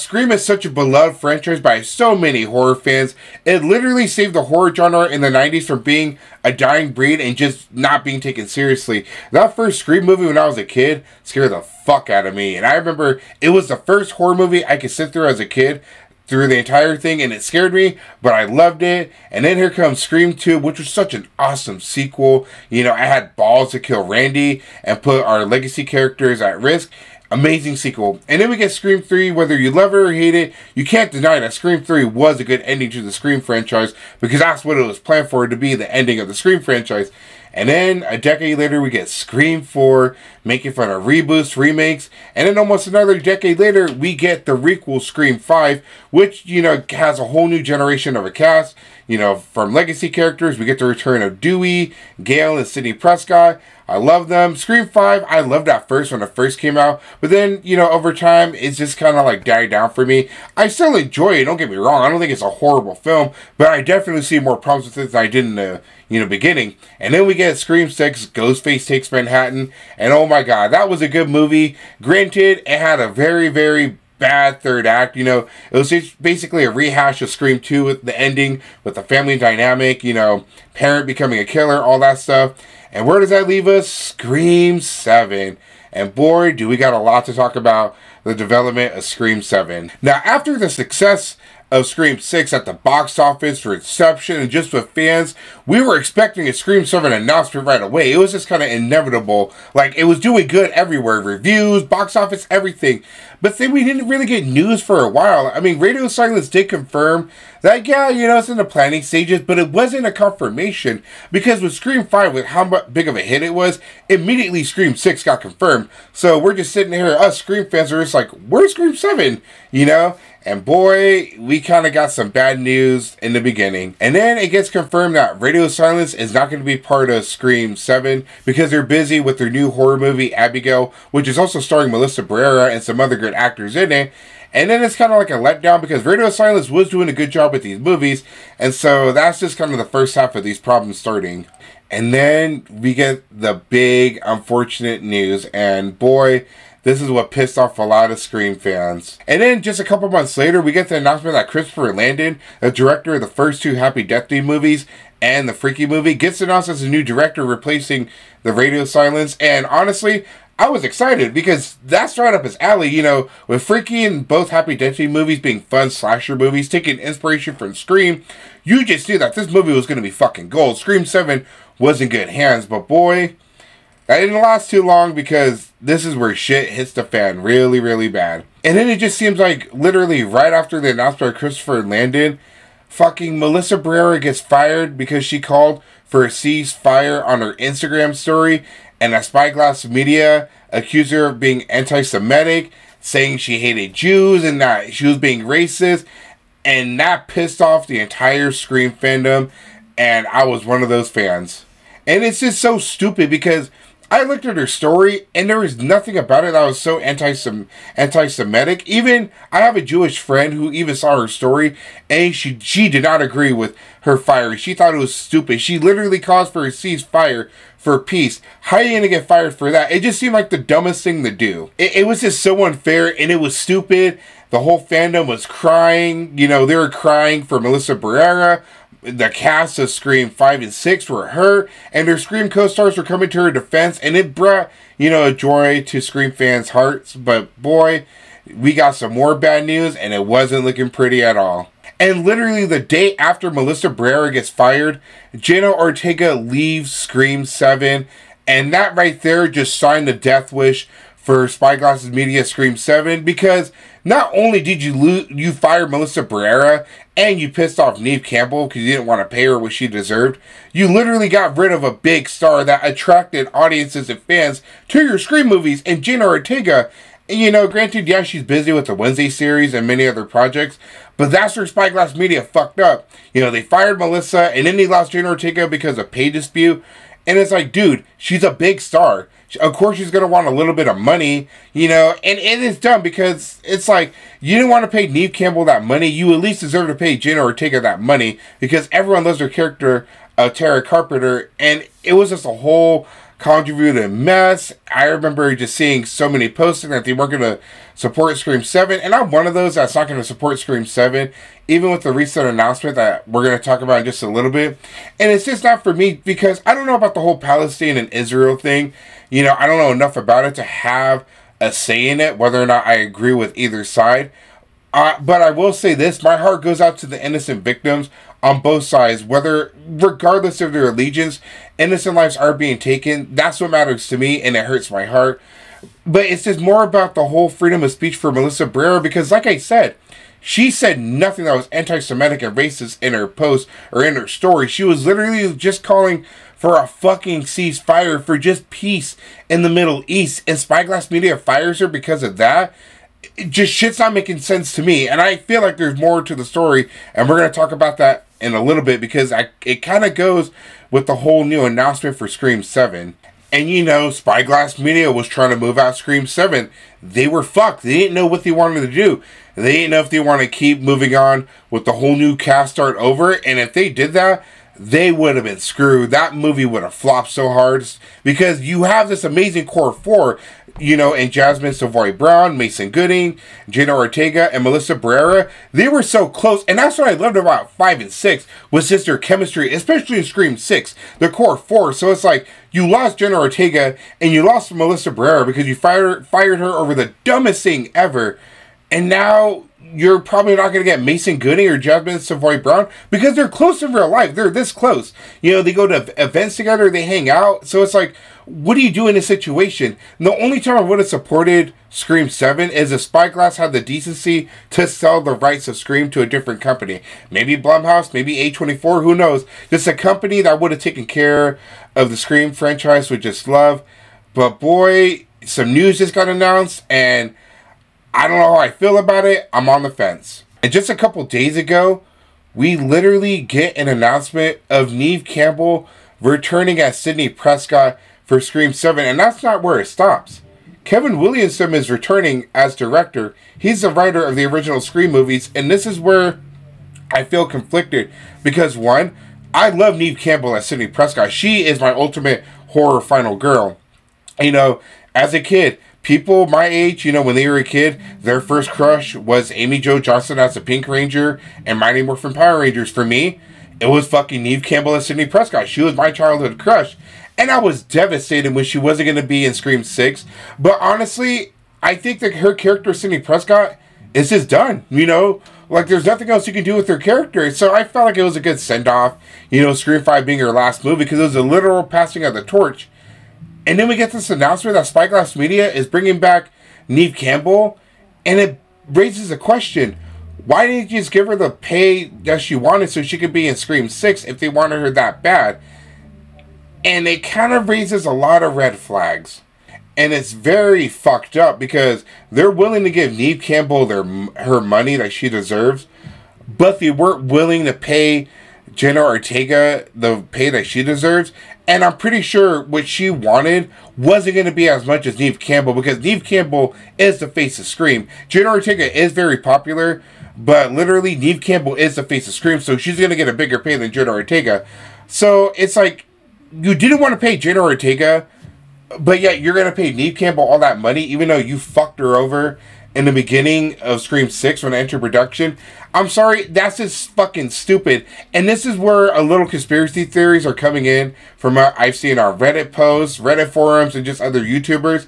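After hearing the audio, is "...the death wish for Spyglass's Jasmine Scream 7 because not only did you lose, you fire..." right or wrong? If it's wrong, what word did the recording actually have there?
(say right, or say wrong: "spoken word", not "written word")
wrong: "Media", not "Jasmine".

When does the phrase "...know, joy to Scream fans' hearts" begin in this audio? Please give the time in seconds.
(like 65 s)
235 s.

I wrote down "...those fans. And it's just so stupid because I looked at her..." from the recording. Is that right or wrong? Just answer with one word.
right.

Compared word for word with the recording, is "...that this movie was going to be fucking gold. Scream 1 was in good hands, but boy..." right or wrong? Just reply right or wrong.
wrong.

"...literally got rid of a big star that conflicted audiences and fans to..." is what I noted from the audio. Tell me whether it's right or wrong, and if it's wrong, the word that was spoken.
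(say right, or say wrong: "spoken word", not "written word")
wrong: "attracted", not "conflicted".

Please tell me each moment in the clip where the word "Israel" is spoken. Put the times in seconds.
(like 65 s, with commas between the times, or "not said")
308 s.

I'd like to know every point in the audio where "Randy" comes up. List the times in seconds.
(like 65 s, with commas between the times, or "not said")
24 s.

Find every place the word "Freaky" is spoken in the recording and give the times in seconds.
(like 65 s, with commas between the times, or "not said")
155 s, 163 s.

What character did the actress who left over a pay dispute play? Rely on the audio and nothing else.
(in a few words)
Tara Carpenter.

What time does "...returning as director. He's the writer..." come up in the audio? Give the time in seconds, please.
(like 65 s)
431 s.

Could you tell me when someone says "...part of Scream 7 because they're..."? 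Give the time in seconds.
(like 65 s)
126 s.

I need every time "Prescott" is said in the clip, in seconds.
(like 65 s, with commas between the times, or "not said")
52 s, 427 s, 440 s, 455 s, 463 s.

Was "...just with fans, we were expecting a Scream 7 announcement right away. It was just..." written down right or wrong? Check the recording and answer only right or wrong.
right.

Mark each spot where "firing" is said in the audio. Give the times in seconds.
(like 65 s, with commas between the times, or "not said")
214 s.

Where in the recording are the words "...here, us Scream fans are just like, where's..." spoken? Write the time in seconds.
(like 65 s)
116 s.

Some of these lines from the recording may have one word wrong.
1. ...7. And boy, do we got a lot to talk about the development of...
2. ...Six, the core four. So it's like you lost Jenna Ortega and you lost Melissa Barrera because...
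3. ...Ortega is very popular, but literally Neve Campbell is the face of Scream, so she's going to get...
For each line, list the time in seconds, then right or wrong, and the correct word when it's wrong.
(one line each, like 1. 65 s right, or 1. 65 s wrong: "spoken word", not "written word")
1. 84 s right
2. 380 s right
3. 508 s right.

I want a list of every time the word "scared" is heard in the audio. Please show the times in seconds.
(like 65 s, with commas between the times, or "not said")
11 s, 17 s.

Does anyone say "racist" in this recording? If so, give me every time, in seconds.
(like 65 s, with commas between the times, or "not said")
195 s, 332 s.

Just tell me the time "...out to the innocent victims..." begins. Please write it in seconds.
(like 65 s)
316 s.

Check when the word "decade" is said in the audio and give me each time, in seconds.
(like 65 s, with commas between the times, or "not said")
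38 s, 43 s.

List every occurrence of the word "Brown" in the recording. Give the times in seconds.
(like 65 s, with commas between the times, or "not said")
372 s, 392 s.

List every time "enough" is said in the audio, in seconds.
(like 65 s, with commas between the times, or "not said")
309 s.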